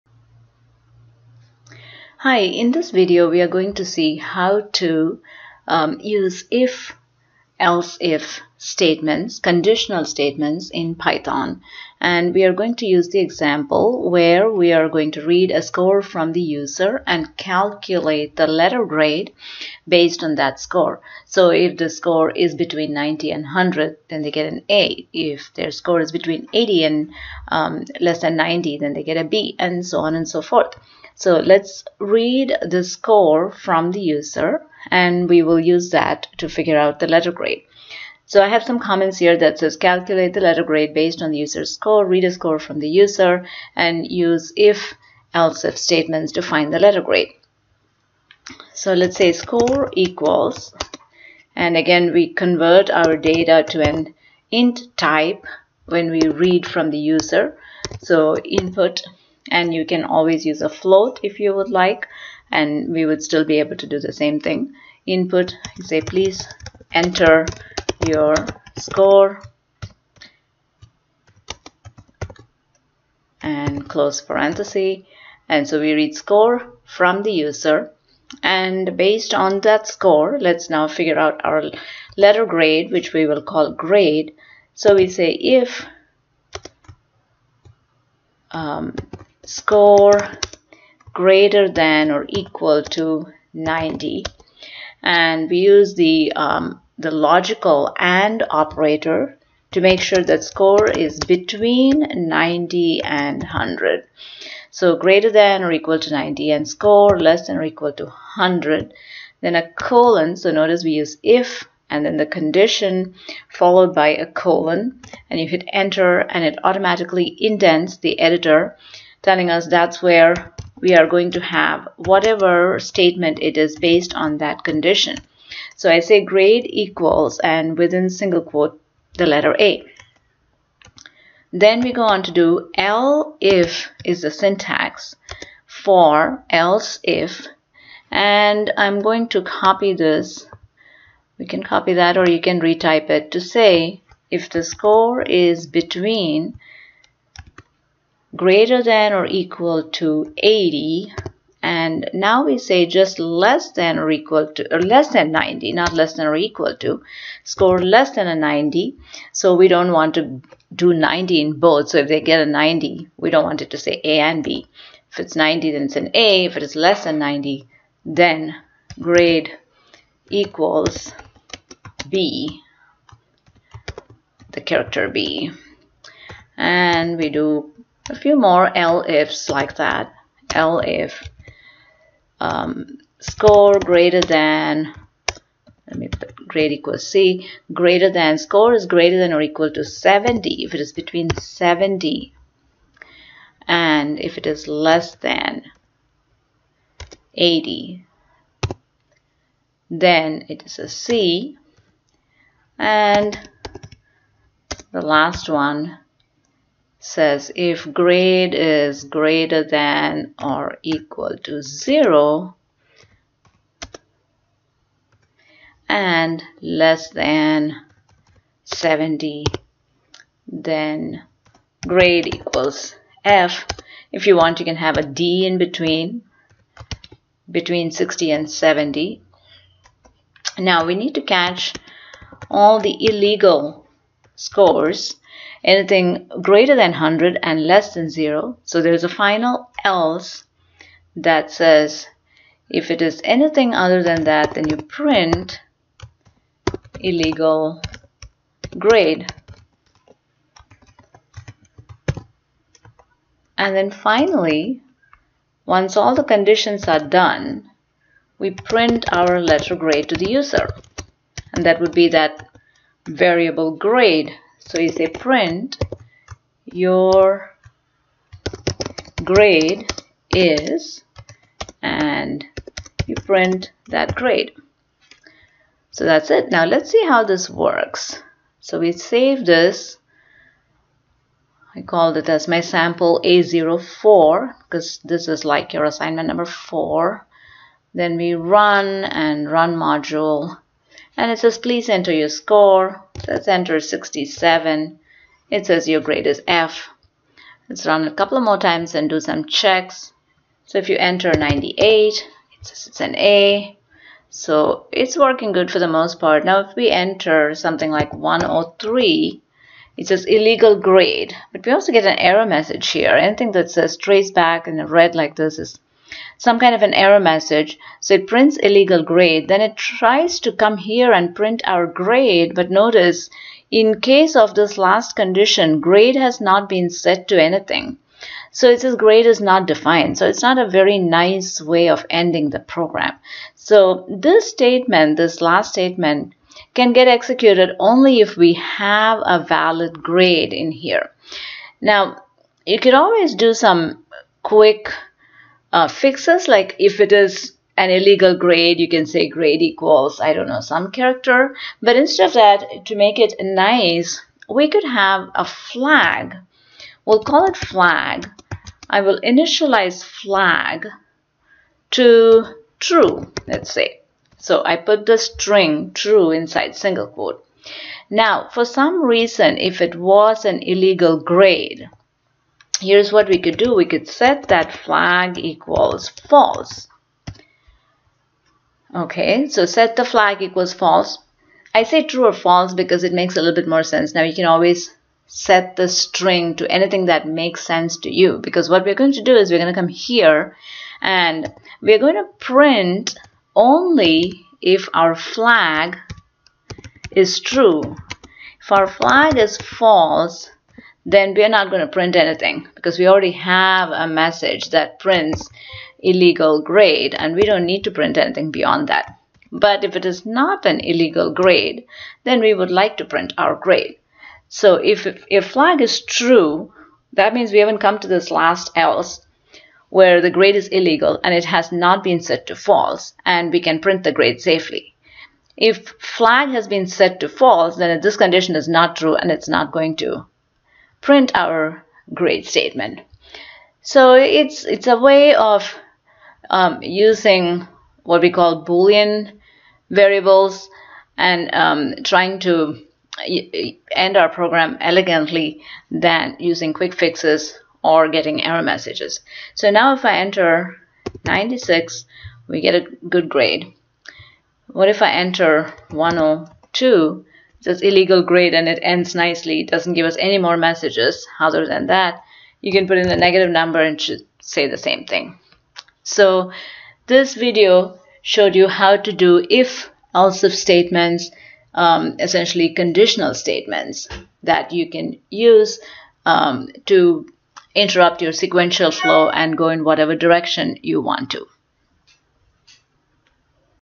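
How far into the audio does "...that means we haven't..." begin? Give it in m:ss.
6:57.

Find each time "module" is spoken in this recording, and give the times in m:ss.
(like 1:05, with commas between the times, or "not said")
4:49.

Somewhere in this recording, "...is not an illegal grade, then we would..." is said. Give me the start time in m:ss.
6:50.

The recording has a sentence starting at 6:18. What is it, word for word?
Okay, so set the flag equals false.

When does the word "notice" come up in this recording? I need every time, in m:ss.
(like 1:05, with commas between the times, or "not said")
1:50, 5:22.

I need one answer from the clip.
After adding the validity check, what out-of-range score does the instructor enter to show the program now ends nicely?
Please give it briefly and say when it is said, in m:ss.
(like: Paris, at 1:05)
102, at 7:35.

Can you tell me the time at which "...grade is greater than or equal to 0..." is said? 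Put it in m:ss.
3:27.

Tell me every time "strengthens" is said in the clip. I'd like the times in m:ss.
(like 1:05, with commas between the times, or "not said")
not said.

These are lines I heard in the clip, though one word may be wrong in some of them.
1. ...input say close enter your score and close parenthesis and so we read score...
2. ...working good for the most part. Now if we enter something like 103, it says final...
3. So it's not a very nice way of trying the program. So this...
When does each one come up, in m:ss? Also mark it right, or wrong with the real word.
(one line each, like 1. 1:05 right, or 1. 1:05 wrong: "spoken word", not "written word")
1. 1:05 wrong: "please", not "close"
2. 5:05 wrong: "illegal", not "final"
3. 5:30 wrong: "ending", not "trying".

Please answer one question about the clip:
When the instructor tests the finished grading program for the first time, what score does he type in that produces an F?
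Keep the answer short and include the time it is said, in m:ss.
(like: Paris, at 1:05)
67, at 4:53.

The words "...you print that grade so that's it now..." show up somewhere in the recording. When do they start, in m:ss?
4:33.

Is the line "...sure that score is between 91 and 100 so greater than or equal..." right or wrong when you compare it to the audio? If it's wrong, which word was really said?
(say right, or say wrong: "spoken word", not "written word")
wrong: "90", not "91".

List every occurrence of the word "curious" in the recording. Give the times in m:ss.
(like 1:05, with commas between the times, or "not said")
not said.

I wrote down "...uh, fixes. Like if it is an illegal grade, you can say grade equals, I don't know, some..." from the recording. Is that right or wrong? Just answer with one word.
right.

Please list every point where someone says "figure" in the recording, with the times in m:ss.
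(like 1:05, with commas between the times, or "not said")
0:36, 1:20.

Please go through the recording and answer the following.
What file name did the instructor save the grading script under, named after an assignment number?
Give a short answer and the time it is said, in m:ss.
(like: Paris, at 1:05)
sample A04, at 4:42.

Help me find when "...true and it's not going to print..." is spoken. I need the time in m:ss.
7:08.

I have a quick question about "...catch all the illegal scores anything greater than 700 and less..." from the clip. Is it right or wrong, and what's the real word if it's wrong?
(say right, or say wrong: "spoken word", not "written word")
wrong: "100", not "700".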